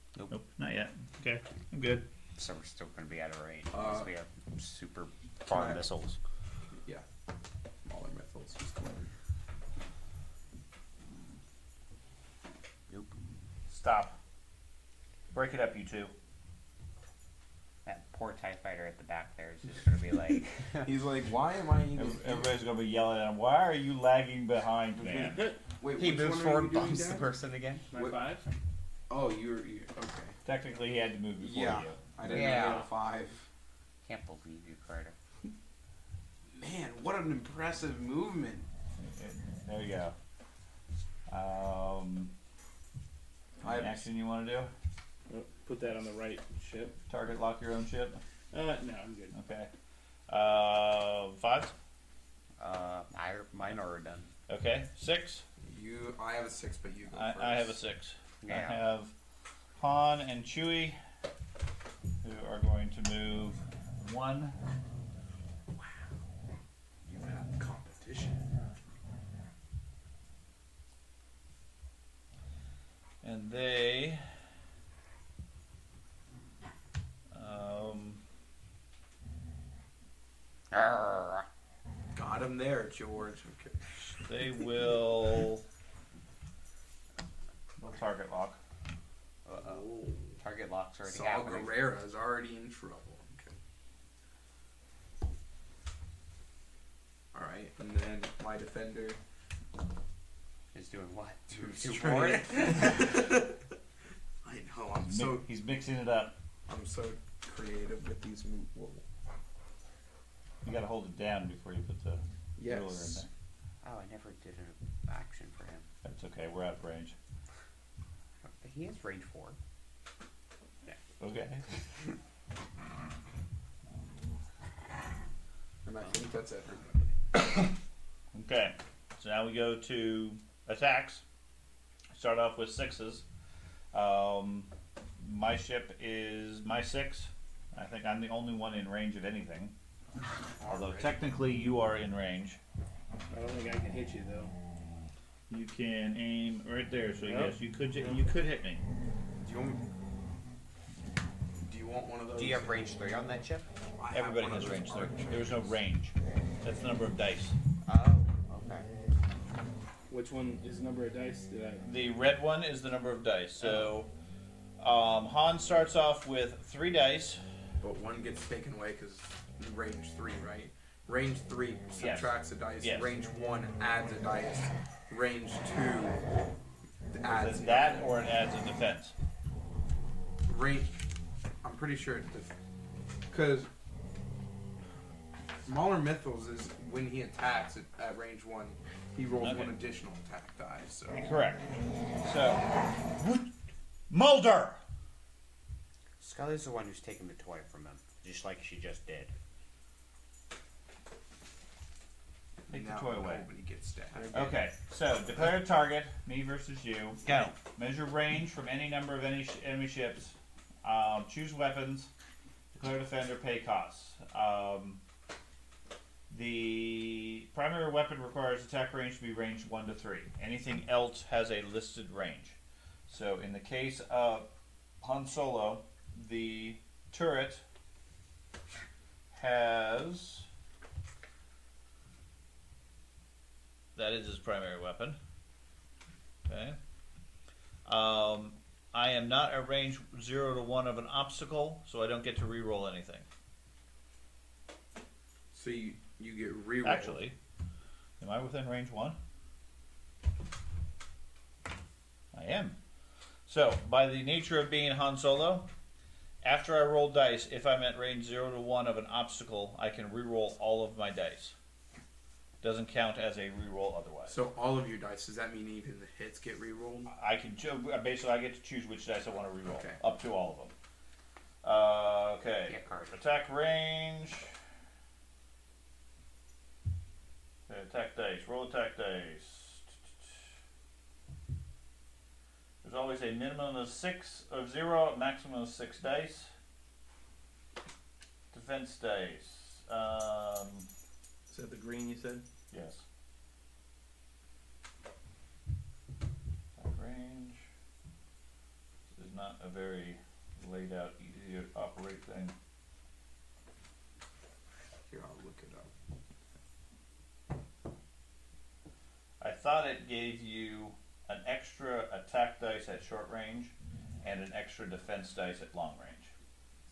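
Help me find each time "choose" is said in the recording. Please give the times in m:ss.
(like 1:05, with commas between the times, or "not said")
3:31, 4:28.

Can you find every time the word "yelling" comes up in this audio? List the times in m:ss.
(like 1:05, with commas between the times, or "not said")
0:22.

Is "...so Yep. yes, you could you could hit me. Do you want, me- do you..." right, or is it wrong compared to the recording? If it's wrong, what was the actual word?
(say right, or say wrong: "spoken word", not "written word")
right.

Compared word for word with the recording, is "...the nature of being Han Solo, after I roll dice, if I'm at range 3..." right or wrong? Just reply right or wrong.
wrong.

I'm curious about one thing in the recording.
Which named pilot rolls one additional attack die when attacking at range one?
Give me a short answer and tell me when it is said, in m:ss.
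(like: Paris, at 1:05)
Mauler Mithel, at 3:05.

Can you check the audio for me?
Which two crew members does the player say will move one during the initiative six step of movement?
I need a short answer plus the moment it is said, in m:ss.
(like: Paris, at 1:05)
Han and Chewie, at 0:59.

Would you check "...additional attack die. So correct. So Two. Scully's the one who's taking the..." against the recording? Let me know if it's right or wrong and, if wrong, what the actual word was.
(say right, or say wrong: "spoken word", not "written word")
wrong: "Mulder", not "Two".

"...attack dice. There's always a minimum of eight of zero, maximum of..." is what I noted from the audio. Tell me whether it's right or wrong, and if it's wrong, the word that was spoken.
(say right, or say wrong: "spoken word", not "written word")
wrong: "six", not "eight".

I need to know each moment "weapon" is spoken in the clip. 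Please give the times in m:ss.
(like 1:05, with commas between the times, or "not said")
3:31, 3:37, 3:54.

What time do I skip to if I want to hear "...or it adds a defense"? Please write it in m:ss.
2:58.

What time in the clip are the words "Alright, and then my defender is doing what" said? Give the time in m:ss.
1:37.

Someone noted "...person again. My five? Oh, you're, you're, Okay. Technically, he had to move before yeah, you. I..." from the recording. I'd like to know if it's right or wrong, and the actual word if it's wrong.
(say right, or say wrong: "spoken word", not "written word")
right.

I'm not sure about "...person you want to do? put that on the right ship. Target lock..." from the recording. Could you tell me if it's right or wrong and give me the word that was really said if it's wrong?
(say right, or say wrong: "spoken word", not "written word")
wrong: "action", not "person".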